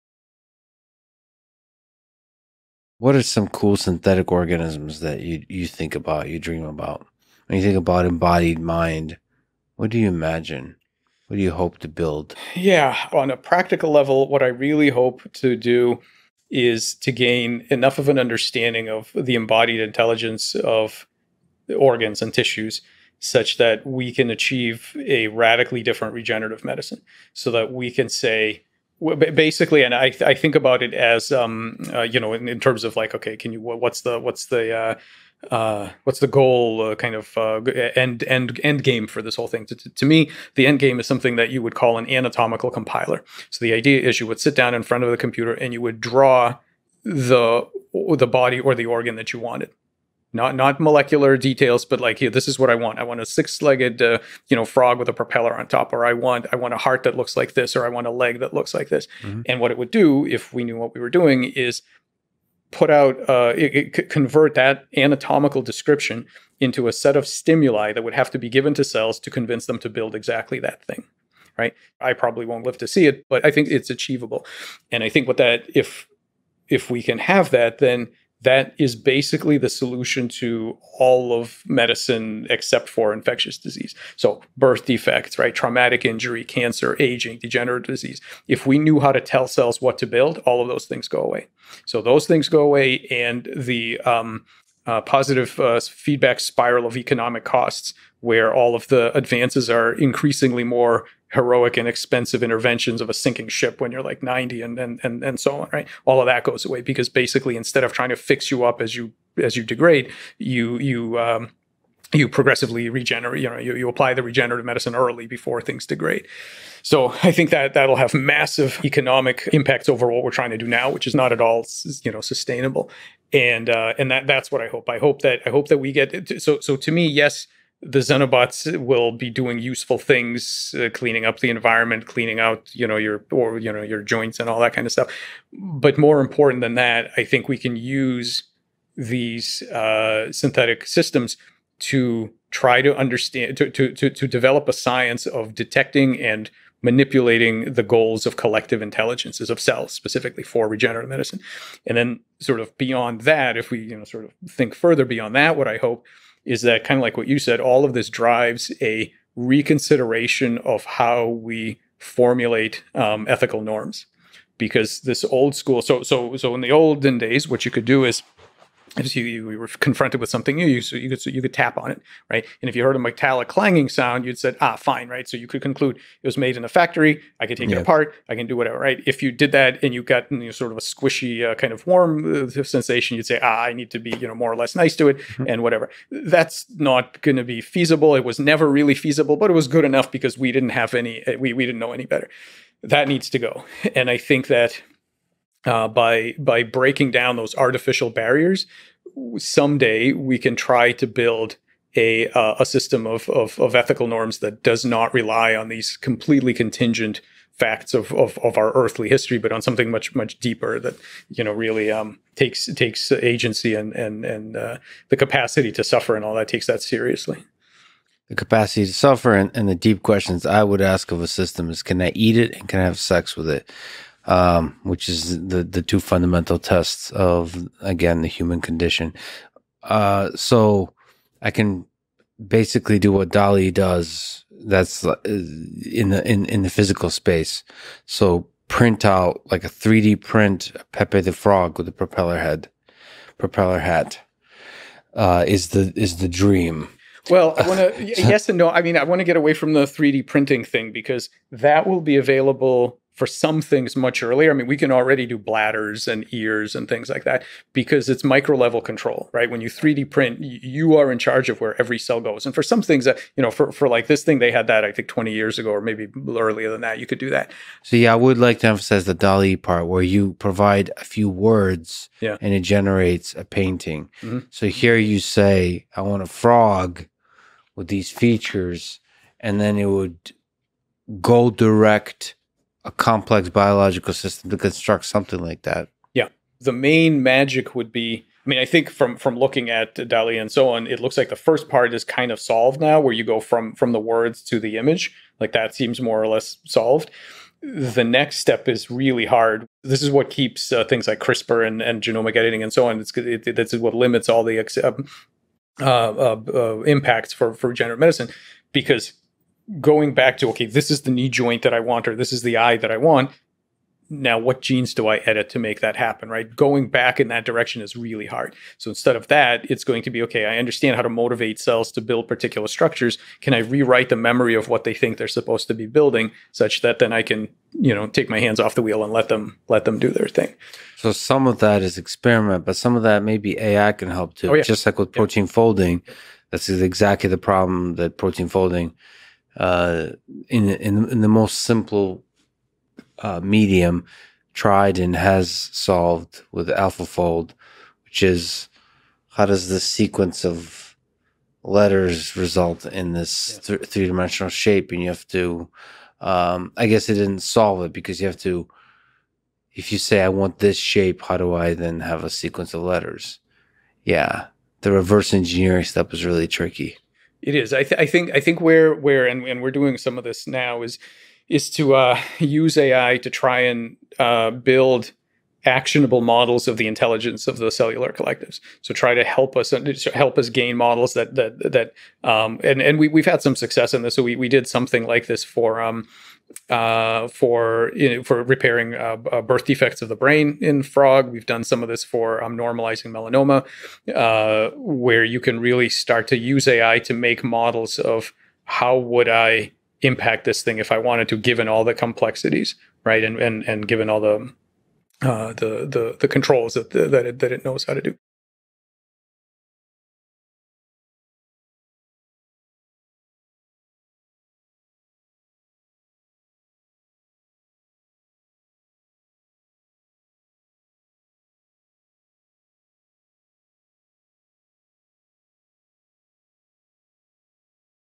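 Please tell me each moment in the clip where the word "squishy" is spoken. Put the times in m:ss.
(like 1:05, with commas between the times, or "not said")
3:00.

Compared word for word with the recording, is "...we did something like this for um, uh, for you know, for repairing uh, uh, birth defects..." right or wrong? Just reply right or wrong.
right.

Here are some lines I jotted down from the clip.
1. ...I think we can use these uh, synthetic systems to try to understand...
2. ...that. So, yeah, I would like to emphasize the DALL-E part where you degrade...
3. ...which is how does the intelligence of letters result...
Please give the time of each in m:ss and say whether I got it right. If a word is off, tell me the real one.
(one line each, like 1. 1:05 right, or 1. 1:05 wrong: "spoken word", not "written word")
1. 2:17 right
2. 4:27 wrong: "provide", not "degrade"
3. 5:48 wrong: "sequence", not "intelligence".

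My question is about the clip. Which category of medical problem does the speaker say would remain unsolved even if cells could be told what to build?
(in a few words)
infectious disease.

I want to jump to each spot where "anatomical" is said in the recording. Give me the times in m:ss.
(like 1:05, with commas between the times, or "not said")
0:42, 1:04.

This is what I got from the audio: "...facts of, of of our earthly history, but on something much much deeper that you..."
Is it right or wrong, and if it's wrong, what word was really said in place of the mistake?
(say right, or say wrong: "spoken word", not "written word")
right.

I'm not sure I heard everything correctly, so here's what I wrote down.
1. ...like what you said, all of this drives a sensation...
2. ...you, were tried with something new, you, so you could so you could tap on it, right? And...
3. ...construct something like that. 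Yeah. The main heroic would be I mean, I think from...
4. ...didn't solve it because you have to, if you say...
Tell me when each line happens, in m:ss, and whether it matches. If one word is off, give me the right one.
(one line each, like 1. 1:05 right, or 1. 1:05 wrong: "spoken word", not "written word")
1. 2:37 wrong: "reconsideration", not "sensation"
2. 2:49 wrong: "confronted", not "tried"
3. 4:44 wrong: "magic", not "heroic"
4. 5:57 right.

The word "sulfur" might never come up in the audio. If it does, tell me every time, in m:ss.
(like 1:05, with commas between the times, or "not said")
not said.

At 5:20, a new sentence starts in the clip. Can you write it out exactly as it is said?
I understand how to motivate cells to build particular structures.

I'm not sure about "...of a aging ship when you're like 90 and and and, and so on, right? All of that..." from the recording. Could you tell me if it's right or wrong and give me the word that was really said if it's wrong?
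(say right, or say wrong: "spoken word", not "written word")
wrong: "sinking", not "aging".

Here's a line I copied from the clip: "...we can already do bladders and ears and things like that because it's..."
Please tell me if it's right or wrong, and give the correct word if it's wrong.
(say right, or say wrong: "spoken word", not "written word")
right.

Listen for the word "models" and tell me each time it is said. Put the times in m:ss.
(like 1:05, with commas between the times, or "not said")
6:16, 6:20, 6:37.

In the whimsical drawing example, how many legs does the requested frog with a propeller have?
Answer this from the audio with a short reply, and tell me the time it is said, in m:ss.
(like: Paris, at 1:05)
6, at 0:53.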